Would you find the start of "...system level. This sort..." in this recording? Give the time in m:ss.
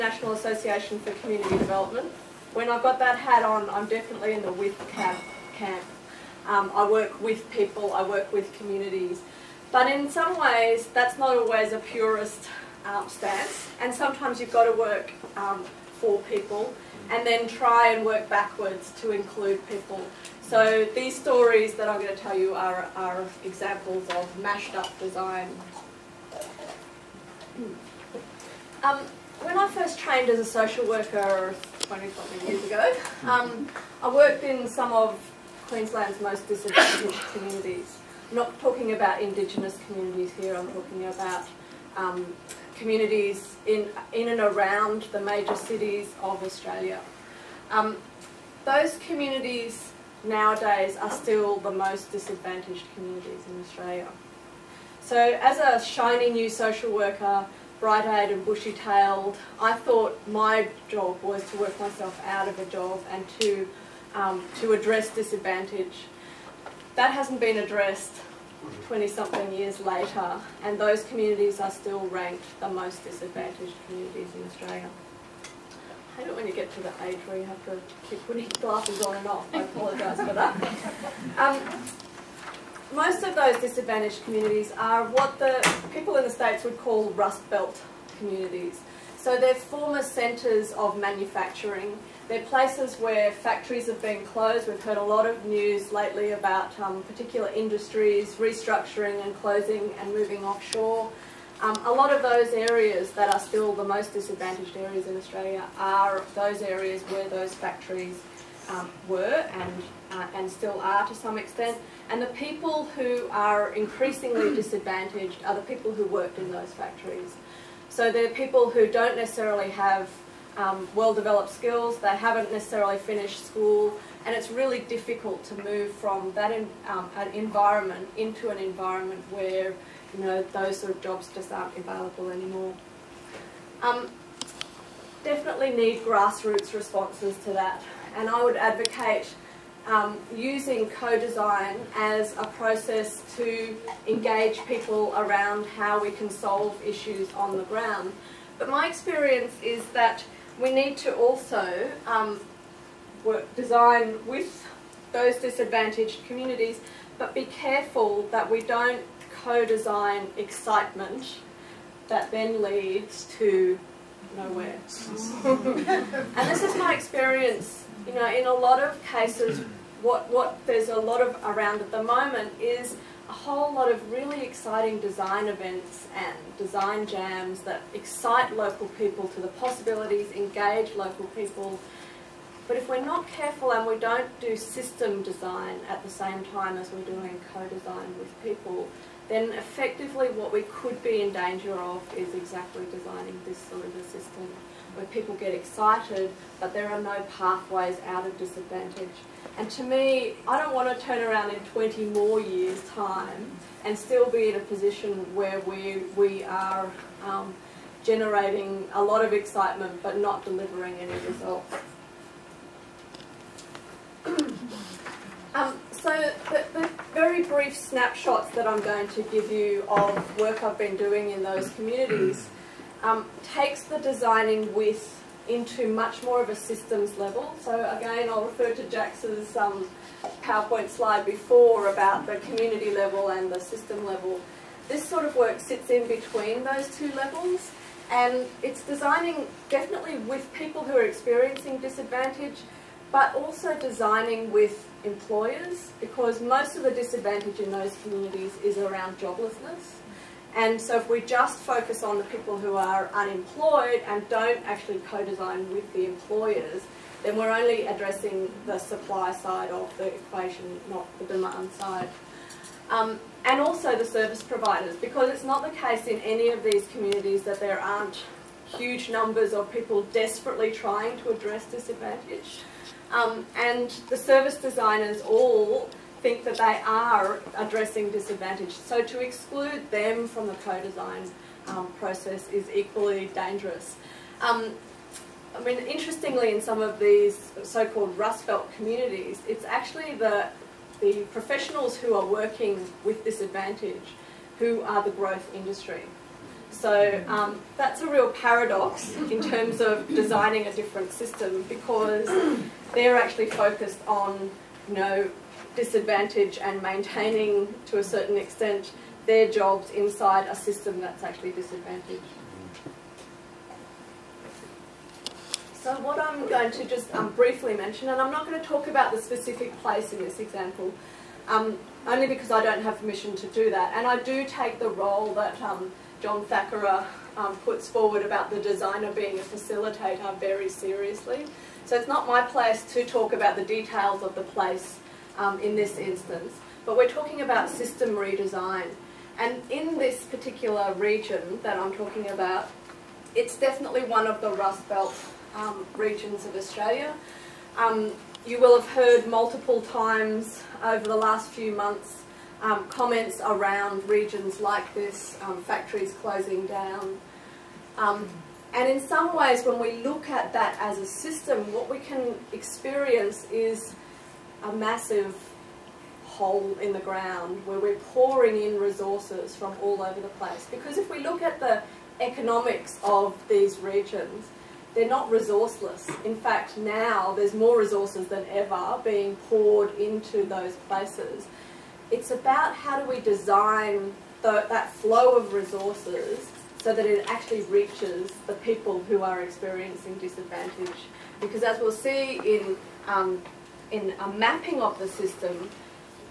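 3:53.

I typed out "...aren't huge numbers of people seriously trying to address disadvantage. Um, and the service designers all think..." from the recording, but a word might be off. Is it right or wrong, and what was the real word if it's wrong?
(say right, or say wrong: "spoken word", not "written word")
wrong: "desperately", not "seriously".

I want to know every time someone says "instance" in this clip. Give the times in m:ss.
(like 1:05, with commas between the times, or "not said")
5:35.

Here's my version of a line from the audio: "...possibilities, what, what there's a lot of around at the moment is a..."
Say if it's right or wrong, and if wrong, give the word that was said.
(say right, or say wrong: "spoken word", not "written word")
wrong: "cases", not "possibilities".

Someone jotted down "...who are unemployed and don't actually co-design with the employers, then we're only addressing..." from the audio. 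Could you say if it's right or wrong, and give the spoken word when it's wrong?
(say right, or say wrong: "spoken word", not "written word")
right.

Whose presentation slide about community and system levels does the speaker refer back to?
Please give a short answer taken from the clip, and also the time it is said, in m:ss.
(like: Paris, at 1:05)
Jax, at 3:48.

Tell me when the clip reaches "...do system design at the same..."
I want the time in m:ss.
3:04.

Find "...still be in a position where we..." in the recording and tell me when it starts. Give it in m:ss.
3:23.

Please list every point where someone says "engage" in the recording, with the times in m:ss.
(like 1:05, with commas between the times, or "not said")
2:24, 3:00.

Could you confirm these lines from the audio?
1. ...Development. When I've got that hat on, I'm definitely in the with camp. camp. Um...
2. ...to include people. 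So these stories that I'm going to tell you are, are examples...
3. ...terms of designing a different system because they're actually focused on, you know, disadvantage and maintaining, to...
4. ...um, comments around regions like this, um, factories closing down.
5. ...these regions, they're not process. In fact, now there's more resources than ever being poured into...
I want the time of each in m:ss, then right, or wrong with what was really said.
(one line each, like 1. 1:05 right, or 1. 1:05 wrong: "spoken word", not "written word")
1. 0:01 right
2. 0:19 right
3. 4:59 right
4. 5:52 right
5. 6:13 wrong: "resourceless", not "process".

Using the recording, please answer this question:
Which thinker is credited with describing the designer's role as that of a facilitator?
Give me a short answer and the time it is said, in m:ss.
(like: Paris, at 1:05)
John Thackara, at 5:26.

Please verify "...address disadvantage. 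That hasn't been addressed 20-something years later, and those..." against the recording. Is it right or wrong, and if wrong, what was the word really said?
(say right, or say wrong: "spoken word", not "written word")
right.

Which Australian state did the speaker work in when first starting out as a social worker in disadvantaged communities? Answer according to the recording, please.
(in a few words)
Queensland.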